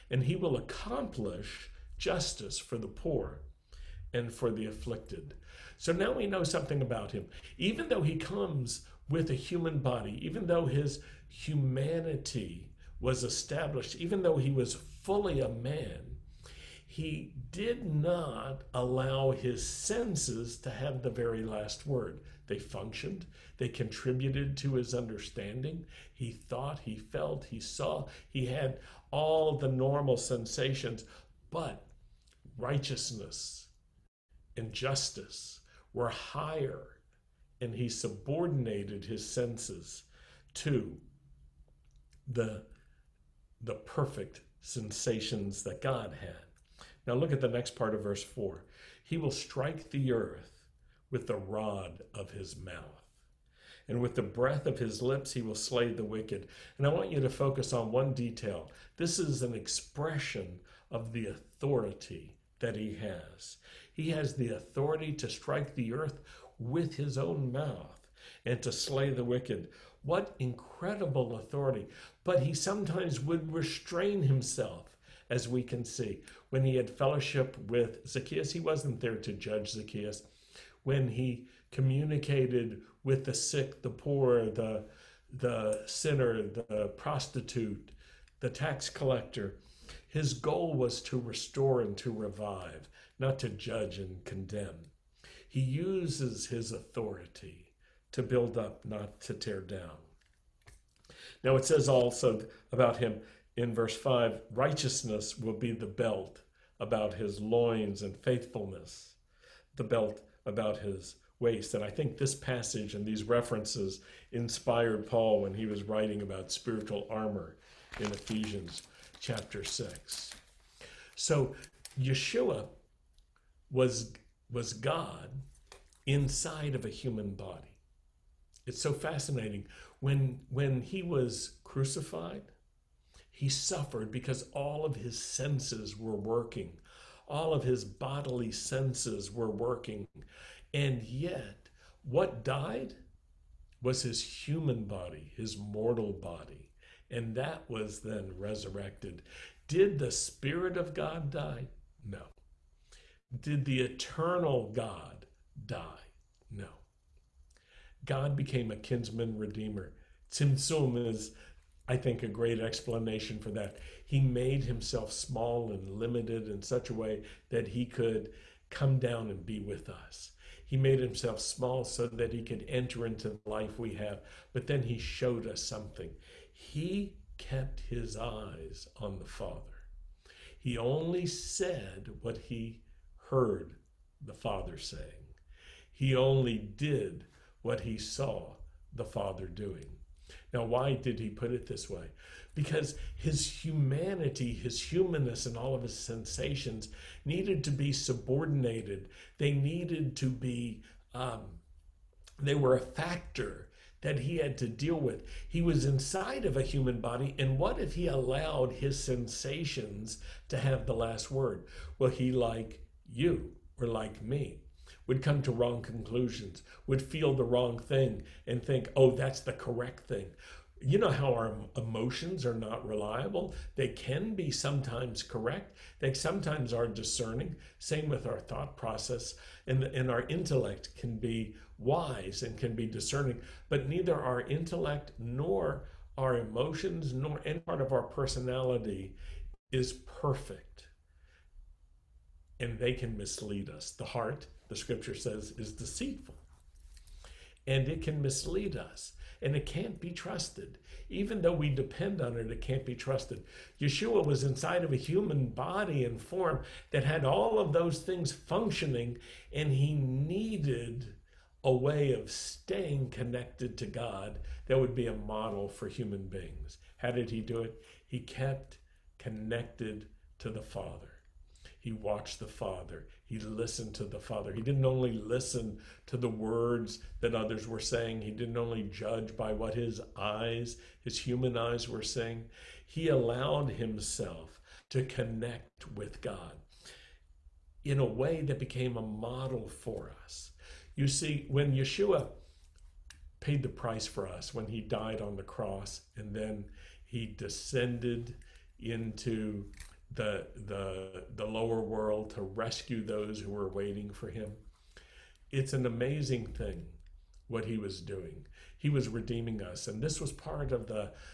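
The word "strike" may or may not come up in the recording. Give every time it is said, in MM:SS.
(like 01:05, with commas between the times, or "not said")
00:49, 01:05.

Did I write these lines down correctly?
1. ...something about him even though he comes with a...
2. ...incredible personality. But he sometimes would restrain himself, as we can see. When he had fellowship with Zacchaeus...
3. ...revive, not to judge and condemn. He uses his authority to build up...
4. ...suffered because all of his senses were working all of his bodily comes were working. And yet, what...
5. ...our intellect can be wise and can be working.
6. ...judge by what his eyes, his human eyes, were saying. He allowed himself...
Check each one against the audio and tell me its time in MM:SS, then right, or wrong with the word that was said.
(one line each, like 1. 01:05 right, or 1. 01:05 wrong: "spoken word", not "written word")
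1. 00:06 right
2. 01:10 wrong: "authority", not "personality"
3. 01:32 right
4. 02:13 wrong: "senses", not "comes"
5. 03:50 wrong: "discerning", not "working"
6. 04:38 right.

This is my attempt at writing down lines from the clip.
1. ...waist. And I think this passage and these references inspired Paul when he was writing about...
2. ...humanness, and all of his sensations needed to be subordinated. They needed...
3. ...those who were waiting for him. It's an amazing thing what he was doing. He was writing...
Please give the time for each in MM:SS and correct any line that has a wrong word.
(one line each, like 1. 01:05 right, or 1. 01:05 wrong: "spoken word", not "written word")
1. 01:51 right
2. 03:14 right
3. 05:03 wrong: "redeeming", not "writing".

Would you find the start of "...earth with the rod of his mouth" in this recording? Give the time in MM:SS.
00:50.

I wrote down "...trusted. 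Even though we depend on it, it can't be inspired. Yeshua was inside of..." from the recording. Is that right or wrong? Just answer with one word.
wrong.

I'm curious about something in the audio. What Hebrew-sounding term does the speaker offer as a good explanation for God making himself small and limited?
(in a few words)
Tsum.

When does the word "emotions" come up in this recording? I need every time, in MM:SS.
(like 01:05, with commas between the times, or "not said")
03:41, 03:56.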